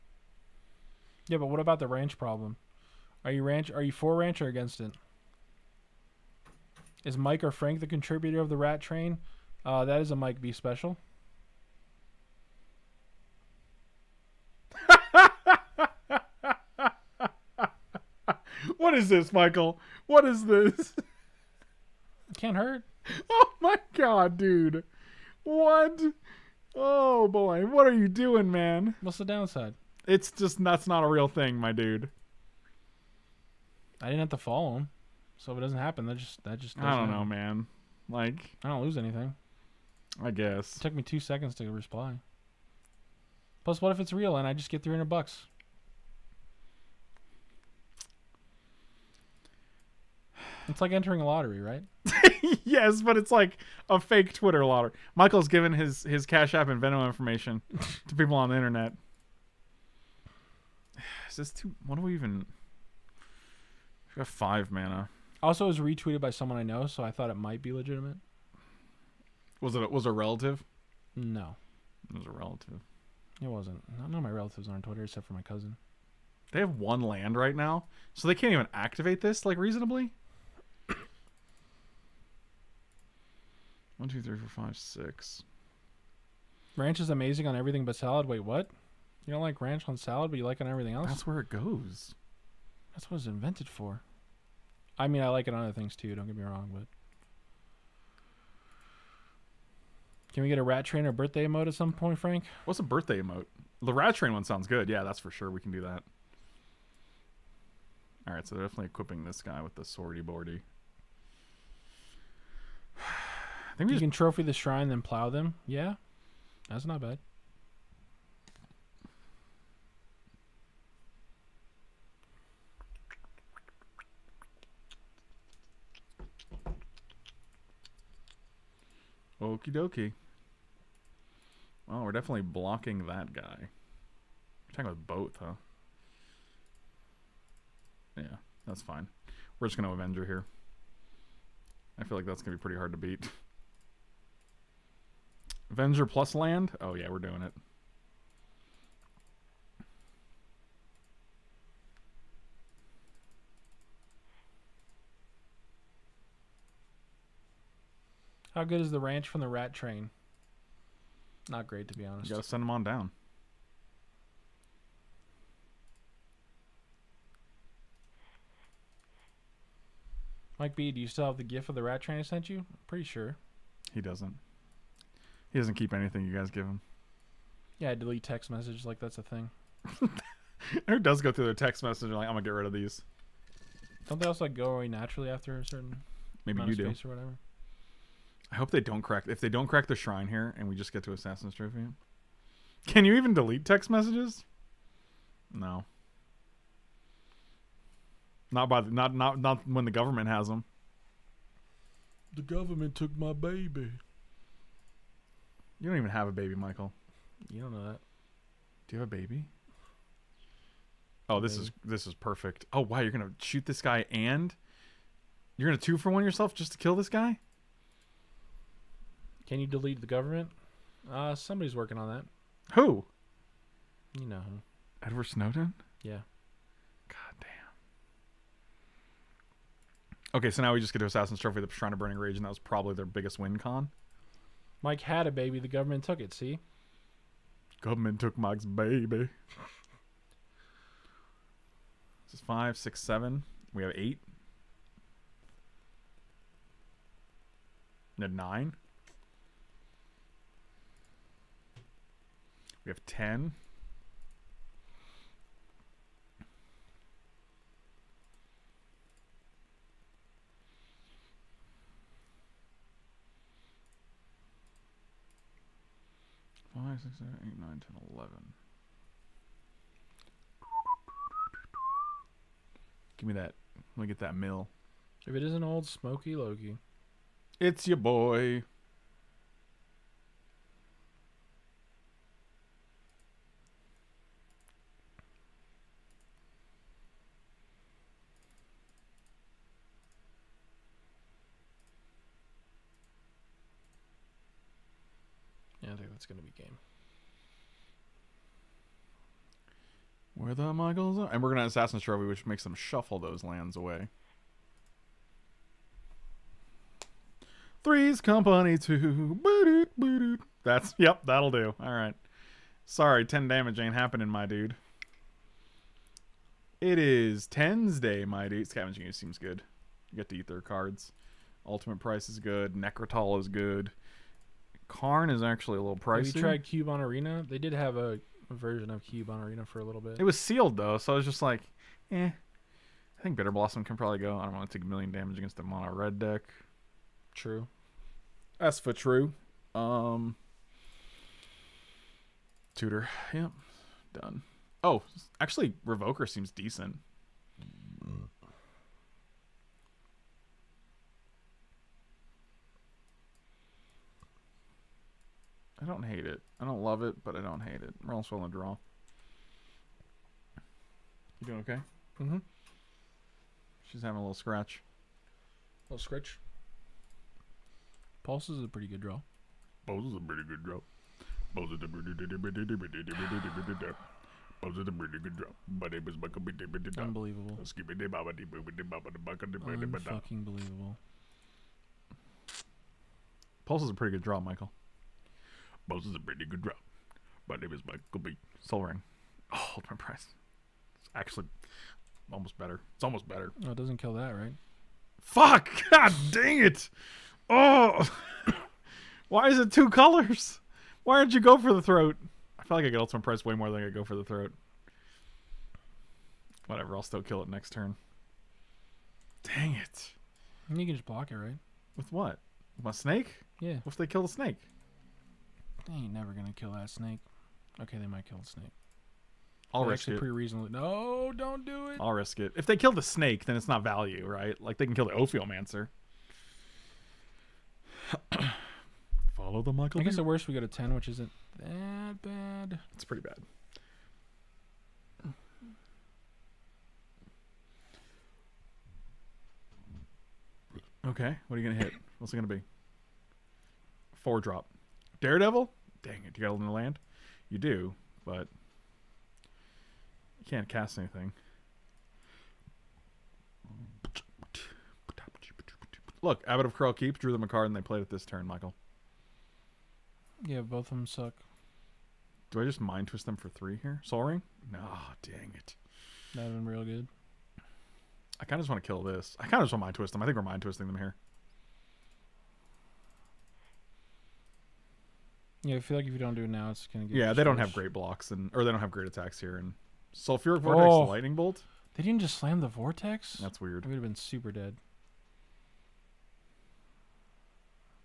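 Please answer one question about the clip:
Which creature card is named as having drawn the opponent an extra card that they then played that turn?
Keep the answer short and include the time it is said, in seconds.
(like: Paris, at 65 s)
Abbot of Keral Keep, at 456 s.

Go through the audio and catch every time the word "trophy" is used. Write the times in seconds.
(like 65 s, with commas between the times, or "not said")
114 s, 191 s, 231 s, 302 s.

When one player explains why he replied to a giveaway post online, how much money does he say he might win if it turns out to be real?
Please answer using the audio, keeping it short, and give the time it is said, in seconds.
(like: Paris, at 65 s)
300 bucks, at 44 s.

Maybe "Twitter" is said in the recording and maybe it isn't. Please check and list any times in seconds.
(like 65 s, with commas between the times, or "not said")
54 s, 74 s.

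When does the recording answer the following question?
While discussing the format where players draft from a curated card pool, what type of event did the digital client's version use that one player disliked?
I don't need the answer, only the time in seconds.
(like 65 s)
330 s.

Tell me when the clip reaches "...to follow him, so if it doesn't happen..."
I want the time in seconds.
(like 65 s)
34 s.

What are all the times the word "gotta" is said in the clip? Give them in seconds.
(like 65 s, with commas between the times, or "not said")
162 s.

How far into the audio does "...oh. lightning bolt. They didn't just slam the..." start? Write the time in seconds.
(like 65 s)
480 s.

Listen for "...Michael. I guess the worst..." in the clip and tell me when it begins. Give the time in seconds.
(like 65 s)
429 s.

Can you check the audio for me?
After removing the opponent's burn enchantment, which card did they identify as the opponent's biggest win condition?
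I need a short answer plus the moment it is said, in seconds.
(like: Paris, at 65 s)
Shrine of Burning Rage, at 231 s.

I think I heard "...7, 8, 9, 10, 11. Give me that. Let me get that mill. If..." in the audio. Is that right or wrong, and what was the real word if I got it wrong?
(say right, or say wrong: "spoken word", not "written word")
right.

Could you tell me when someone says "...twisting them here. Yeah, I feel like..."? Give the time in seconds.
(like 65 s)
470 s.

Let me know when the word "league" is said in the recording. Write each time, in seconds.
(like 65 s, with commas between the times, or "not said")
not said.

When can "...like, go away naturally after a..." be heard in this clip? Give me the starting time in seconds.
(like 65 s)
184 s.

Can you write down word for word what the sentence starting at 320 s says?
You get to eat their cards.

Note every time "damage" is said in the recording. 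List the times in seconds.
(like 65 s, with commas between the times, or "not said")
313 s, 335 s.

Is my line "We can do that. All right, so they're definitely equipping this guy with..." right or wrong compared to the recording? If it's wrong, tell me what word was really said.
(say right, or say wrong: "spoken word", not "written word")
right.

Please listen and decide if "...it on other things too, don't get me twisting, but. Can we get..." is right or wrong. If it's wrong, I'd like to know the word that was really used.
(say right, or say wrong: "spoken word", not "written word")
wrong: "wrong", not "twisting".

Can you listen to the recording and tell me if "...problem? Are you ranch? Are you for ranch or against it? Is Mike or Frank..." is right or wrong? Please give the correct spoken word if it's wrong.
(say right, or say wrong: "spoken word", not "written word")
right.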